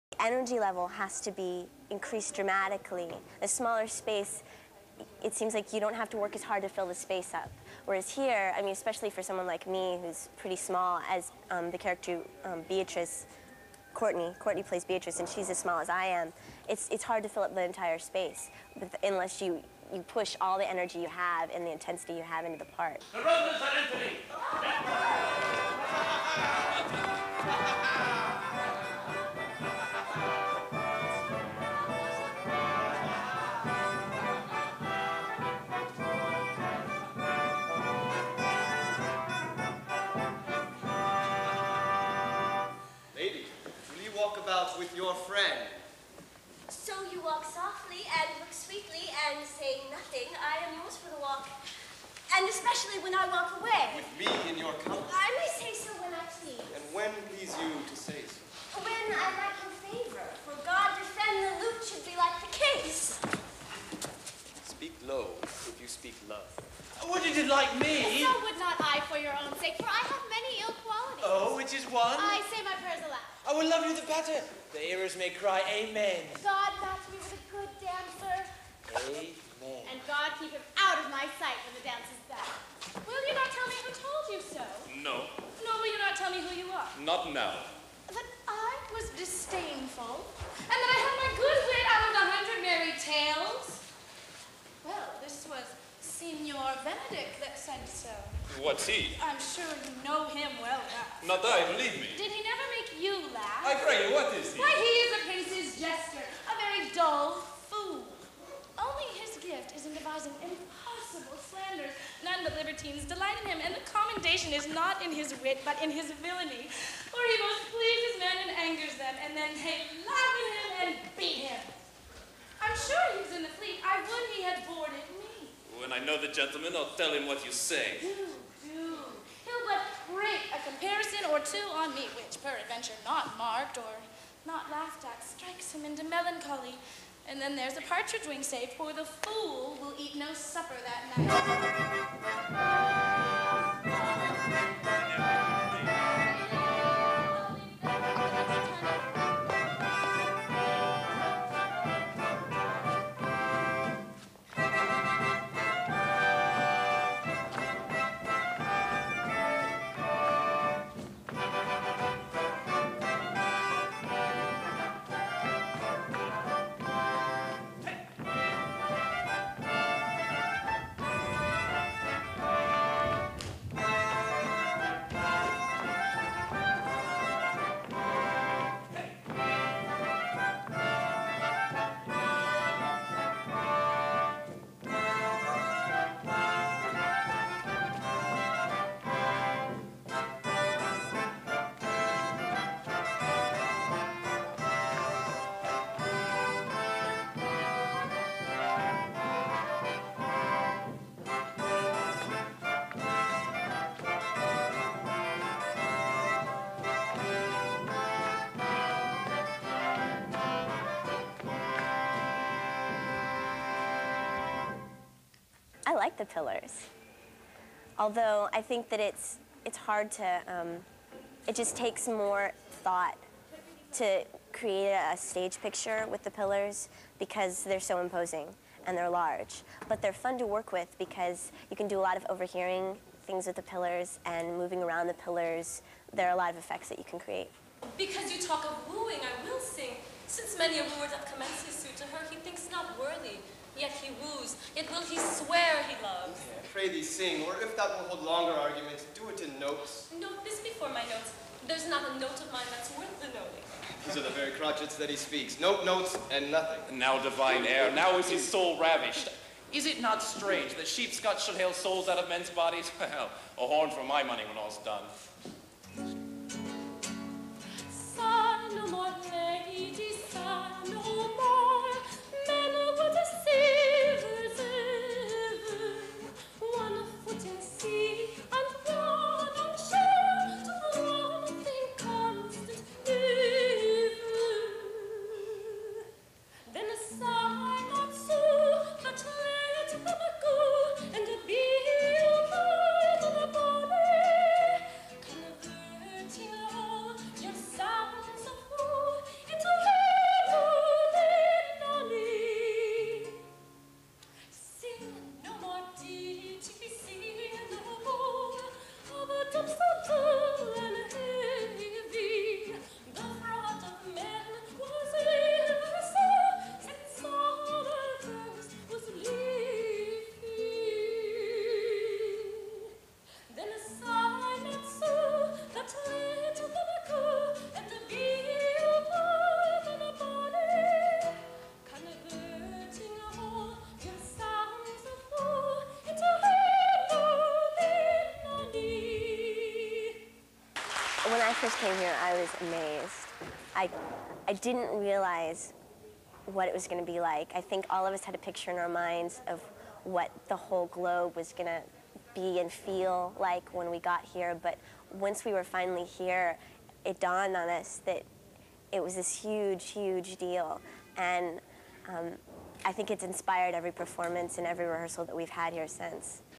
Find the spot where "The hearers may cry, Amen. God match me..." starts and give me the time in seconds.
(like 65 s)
74 s.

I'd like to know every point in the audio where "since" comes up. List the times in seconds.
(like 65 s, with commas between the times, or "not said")
240 s, 365 s.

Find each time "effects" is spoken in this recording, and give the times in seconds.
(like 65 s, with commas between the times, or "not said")
236 s.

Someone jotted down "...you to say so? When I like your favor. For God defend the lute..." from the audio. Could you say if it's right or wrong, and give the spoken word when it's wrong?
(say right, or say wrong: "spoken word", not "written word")
right.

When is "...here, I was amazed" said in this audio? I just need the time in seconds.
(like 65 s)
341 s.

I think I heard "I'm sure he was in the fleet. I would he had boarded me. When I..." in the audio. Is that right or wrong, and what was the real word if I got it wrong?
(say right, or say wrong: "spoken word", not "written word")
right.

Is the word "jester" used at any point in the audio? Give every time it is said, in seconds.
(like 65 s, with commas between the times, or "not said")
105 s.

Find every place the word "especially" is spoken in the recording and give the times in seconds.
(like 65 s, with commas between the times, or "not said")
8 s, 52 s.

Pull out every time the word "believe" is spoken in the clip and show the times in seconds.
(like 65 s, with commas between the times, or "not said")
101 s.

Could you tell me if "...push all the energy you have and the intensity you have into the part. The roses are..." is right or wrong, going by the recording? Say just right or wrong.
right.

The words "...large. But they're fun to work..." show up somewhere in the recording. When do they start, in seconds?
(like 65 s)
229 s.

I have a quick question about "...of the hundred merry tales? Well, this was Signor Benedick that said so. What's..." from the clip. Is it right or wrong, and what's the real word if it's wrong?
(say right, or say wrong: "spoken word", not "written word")
right.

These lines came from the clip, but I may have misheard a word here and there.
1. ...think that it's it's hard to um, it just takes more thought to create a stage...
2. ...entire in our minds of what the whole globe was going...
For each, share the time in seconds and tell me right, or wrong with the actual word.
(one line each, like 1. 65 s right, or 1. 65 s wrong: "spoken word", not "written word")
1. 218 s right
2. 348 s wrong: "picture", not "entire".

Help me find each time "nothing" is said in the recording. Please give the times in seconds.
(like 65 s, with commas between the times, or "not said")
49 s, 256 s.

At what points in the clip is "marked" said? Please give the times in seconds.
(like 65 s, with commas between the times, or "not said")
133 s.